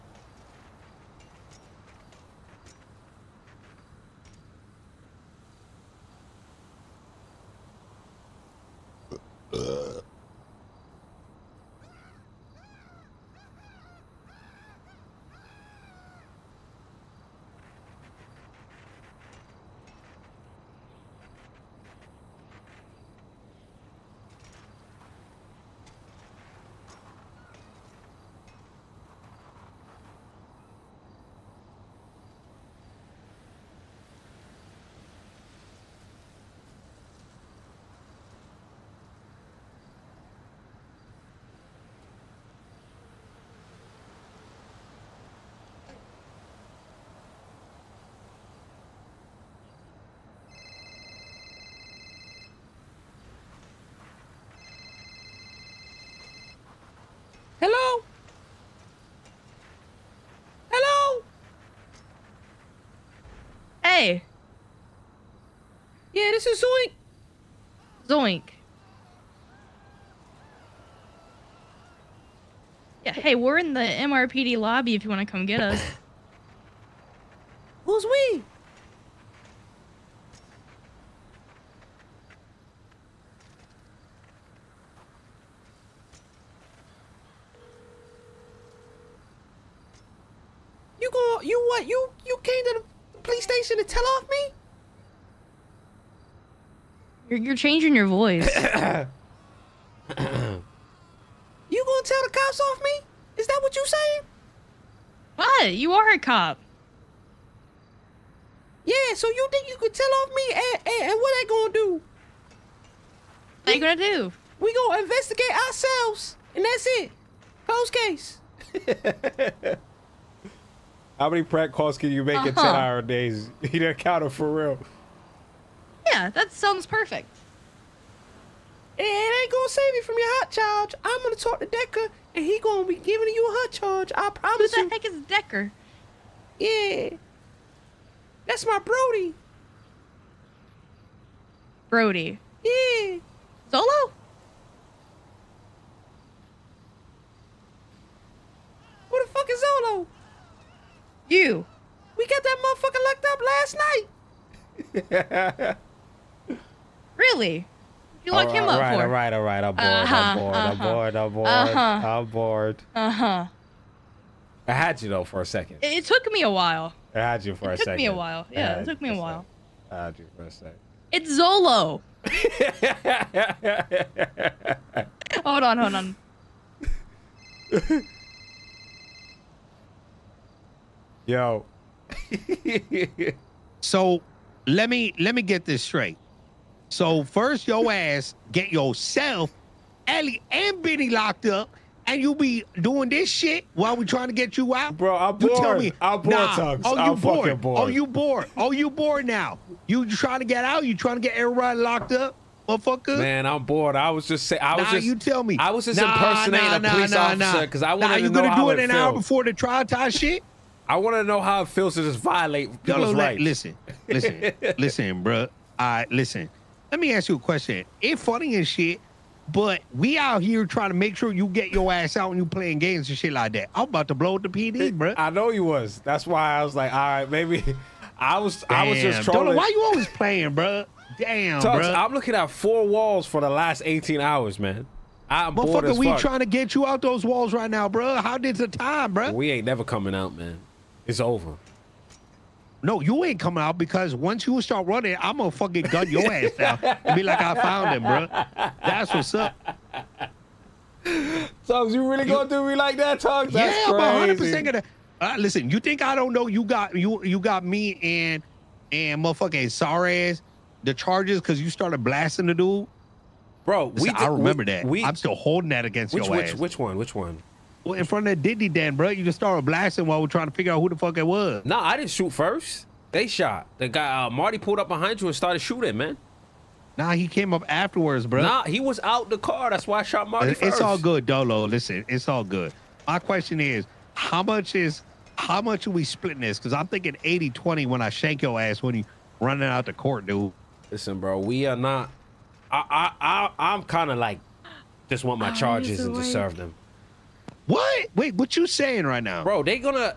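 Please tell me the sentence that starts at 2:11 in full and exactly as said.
I'm gonna talk to Decker, and he gonna be giving you a hot charge.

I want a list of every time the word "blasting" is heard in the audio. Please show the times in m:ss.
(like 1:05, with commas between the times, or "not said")
4:22, 4:29.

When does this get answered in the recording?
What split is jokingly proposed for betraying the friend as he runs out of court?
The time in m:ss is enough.
4:47.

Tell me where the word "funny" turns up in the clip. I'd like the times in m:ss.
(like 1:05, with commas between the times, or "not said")
3:38.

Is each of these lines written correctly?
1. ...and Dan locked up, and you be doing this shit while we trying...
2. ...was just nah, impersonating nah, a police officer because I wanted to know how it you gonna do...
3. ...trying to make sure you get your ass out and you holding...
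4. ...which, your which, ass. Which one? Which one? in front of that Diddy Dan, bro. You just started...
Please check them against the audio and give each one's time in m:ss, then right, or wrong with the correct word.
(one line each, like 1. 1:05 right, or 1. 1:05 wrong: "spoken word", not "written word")
1. 3:10 wrong: "Benny", not "Dan"
2. 3:25 right
3. 3:40 wrong: "playing", not "holding"
4. 4:26 right.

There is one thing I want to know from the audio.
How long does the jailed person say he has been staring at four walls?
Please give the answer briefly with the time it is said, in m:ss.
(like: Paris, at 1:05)
18 hours, at 3:53.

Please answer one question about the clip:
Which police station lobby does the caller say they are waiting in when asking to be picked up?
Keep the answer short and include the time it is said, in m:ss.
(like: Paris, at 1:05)
MRPD, at 1:13.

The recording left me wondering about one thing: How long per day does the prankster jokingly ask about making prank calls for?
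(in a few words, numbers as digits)
10 hours.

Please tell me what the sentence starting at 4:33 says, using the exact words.
The guy uh, Marty pulled up behind you and started shooting, man.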